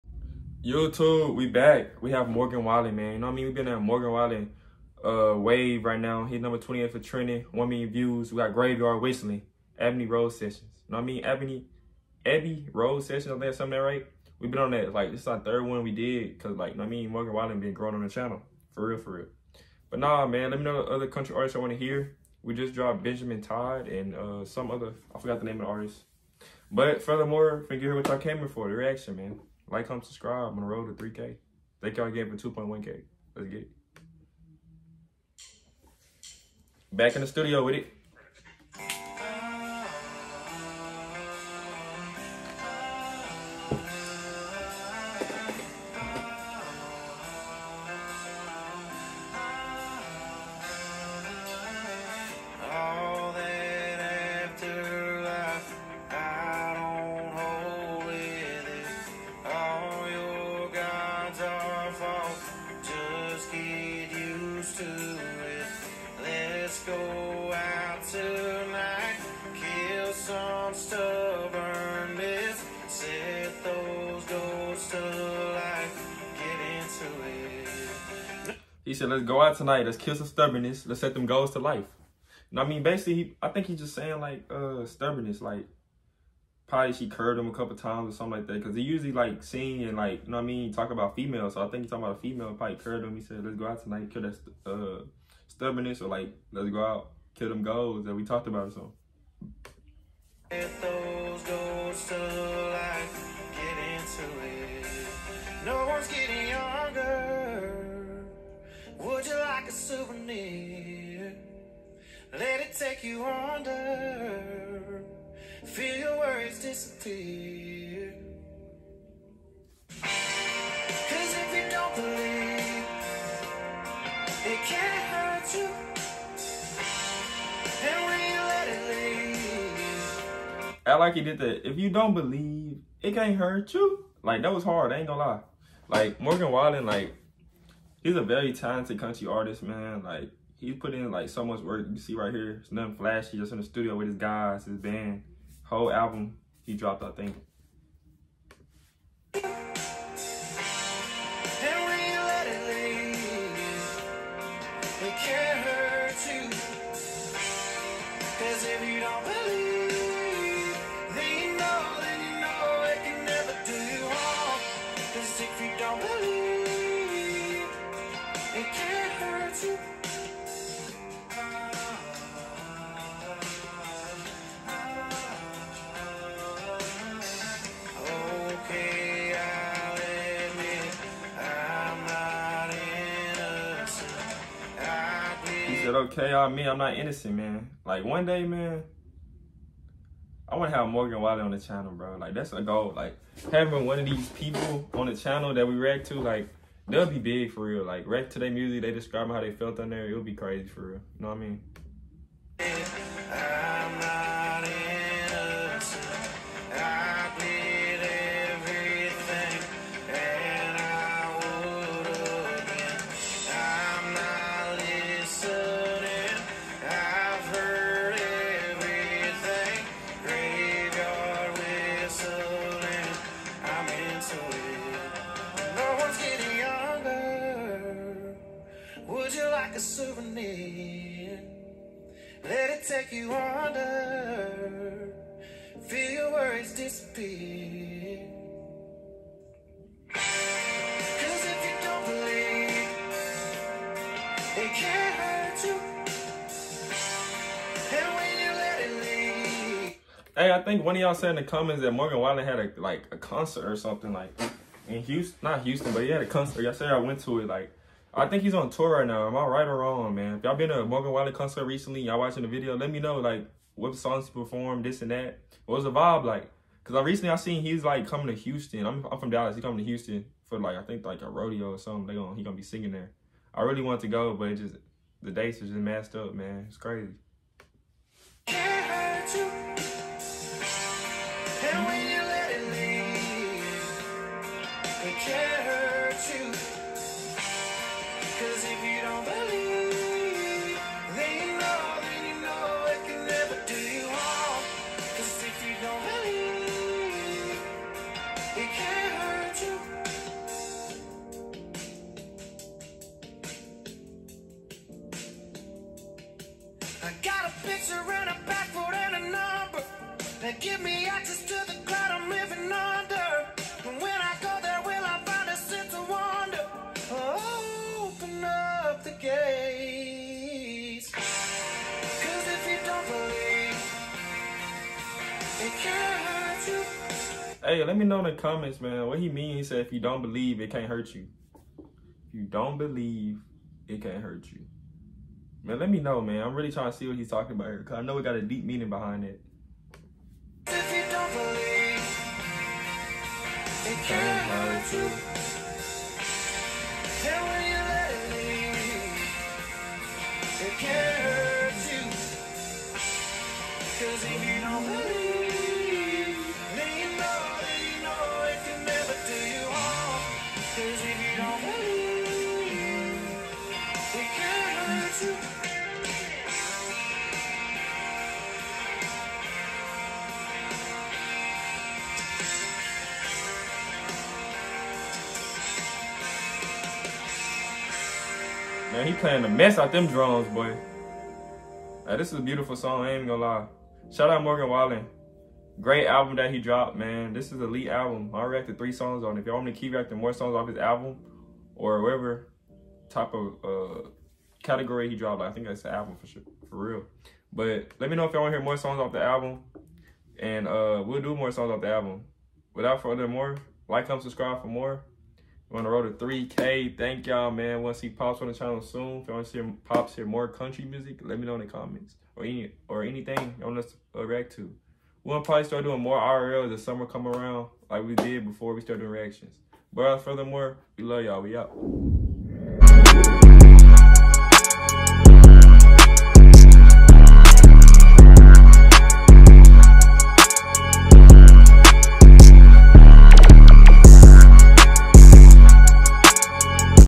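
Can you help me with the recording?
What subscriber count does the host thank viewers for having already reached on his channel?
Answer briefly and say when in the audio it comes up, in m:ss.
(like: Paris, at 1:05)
2.1K, at 0:32.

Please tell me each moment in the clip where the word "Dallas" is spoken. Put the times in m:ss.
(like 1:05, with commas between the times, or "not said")
4:29.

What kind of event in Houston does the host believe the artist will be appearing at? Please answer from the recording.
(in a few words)
A rodeo.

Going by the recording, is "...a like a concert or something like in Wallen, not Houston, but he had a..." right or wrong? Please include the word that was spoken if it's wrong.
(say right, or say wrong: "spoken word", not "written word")
wrong: "Houston", not "Wallen".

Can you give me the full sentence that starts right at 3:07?
Like, one day, man, I want to have Morgan Wallen on the channel, bro.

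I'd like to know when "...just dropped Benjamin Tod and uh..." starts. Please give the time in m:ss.
0:22.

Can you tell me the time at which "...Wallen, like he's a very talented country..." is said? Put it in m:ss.
2:16.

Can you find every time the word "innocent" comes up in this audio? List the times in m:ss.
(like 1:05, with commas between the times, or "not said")
3:06.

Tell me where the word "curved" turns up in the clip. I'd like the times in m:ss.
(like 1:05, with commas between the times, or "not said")
1:27, 1:32.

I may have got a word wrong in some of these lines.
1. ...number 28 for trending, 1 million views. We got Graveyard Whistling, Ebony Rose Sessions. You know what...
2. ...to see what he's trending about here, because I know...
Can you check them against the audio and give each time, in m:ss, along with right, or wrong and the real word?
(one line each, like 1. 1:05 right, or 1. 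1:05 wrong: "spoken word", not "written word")
1. 0:06 right
2. 5:36 wrong: "talking", not "trending".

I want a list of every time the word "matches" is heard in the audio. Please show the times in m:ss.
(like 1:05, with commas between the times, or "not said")
not said.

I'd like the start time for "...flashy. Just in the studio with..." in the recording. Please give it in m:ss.
2:22.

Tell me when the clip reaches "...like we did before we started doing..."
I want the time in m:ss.
6:57.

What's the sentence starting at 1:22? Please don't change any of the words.
And I mean, basically, he, I think he's just saying, like, uh, stubbornness.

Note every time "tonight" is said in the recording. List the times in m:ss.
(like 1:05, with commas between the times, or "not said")
1:19, 1:33.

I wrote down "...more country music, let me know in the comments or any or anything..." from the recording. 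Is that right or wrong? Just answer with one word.
right.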